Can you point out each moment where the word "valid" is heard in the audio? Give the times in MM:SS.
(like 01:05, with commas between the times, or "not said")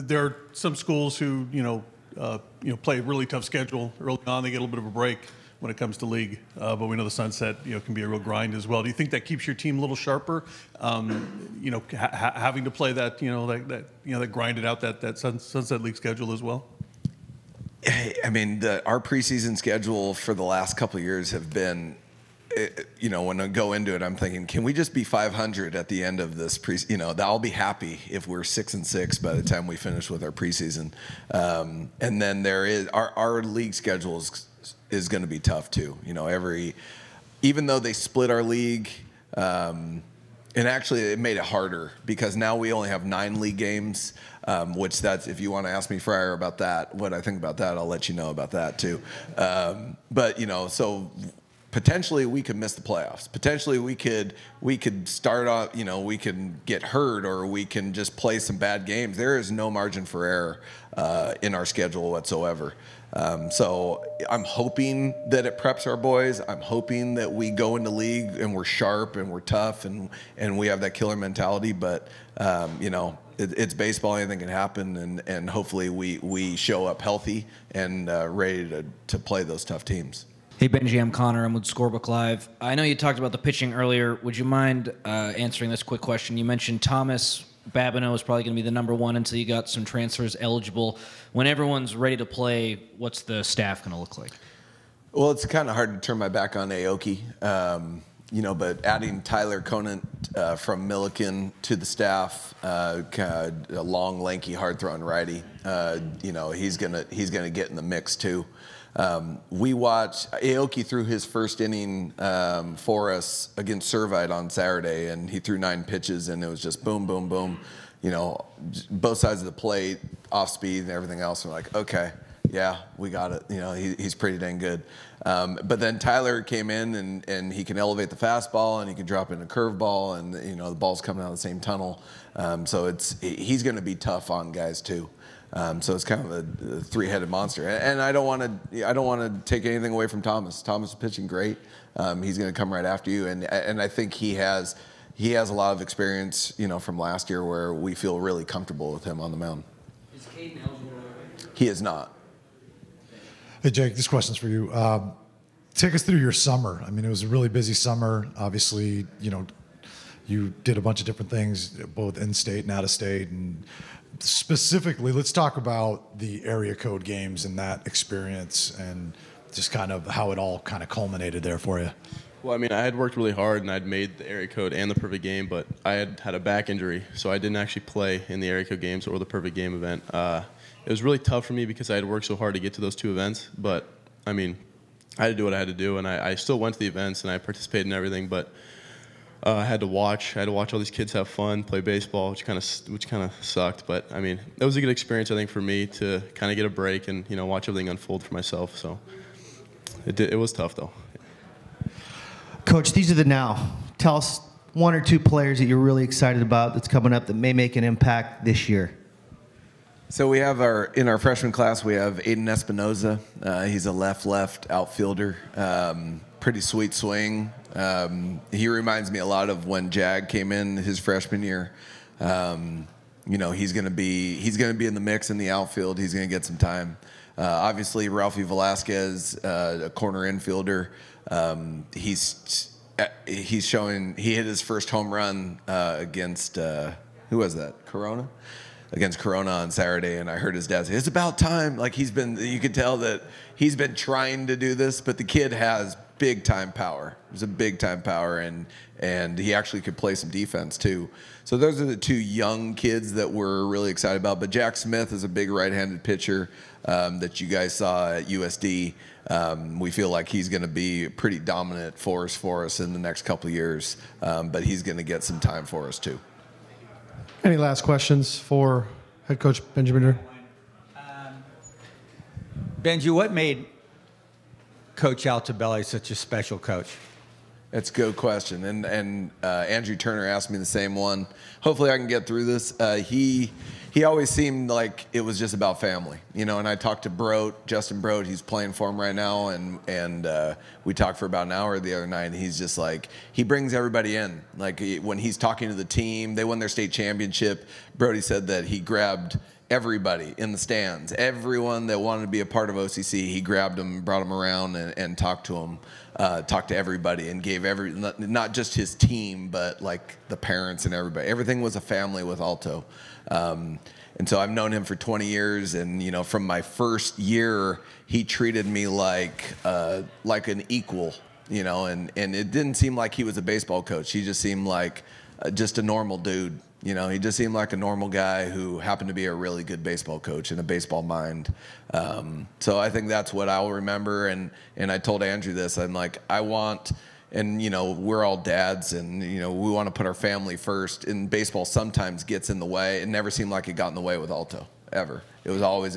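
not said.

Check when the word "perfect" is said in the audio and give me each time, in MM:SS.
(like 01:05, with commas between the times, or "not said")
02:54, 02:59.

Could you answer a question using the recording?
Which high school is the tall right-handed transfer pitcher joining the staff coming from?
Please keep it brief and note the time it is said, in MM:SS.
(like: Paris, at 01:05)
Millikan, at 01:40.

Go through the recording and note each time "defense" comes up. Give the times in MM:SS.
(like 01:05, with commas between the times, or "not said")
04:10.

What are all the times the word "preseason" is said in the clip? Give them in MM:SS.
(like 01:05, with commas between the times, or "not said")
00:18, 00:30.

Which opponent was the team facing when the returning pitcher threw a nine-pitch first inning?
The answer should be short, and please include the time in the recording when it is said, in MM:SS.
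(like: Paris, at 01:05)
Servite, at 01:53.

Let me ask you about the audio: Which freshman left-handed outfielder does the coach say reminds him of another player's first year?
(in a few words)
Aiden Espinoza.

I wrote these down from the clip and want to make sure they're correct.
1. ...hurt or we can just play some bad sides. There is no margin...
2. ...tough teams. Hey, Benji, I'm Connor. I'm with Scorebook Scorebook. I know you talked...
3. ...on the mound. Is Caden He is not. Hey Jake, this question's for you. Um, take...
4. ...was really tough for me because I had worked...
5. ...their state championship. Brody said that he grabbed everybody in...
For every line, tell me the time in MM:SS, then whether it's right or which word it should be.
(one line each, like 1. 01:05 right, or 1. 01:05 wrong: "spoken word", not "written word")
1. 00:56 wrong: "games", not "sides"
2. 01:19 wrong: "Live", not "Scorebook"
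3. 02:29 right
4. 03:00 right
5. 04:56 right.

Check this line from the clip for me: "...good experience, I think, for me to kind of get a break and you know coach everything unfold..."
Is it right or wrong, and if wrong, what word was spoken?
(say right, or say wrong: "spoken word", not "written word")
wrong: "watch", not "coach".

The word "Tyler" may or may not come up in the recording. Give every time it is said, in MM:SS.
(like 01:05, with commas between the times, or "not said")
01:39, 02:05.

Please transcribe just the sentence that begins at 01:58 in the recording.
You know, both sides of the plate, off speed, and everything else.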